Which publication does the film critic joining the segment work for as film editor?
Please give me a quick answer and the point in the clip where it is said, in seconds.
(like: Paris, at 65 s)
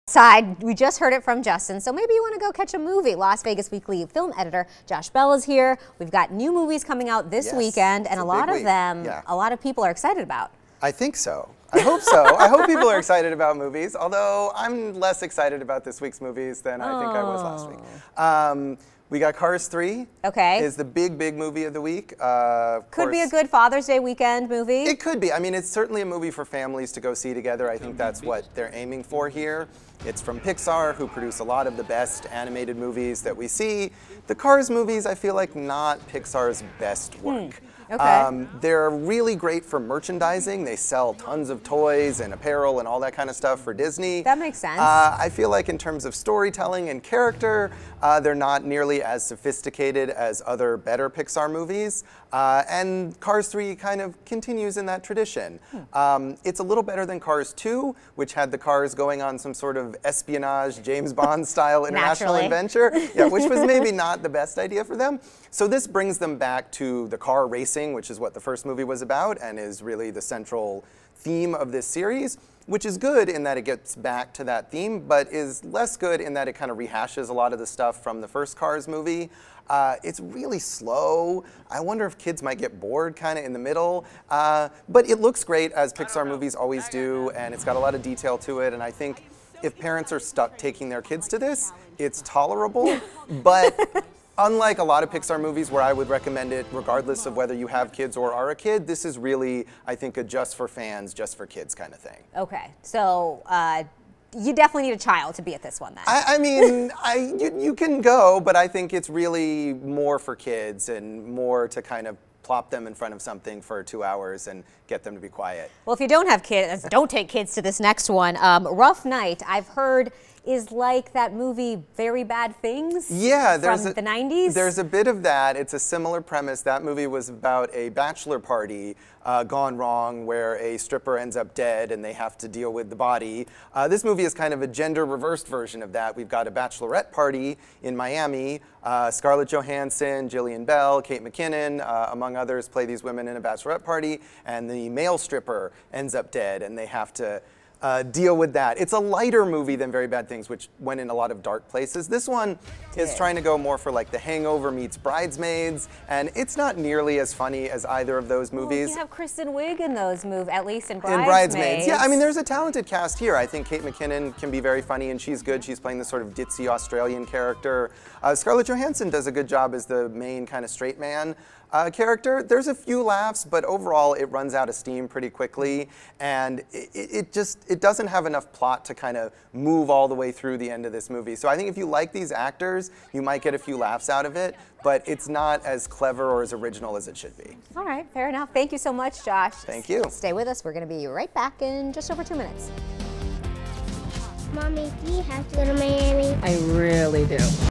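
Las Vegas Weekly, at 3 s.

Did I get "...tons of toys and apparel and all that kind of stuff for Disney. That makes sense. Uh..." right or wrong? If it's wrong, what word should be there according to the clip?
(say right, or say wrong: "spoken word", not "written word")
right.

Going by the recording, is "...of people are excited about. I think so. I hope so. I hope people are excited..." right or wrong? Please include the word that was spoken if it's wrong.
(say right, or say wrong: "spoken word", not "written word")
right.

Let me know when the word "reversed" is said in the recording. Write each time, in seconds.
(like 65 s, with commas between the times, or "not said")
135 s.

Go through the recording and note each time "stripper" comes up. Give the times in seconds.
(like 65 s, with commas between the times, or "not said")
130 s, 145 s.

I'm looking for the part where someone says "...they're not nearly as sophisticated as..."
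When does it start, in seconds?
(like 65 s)
48 s.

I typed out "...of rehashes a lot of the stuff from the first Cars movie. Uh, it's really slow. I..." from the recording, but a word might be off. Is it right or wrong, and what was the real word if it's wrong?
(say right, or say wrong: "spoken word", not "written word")
right.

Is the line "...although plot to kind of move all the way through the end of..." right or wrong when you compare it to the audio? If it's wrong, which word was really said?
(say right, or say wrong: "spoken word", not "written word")
wrong: "enough", not "although".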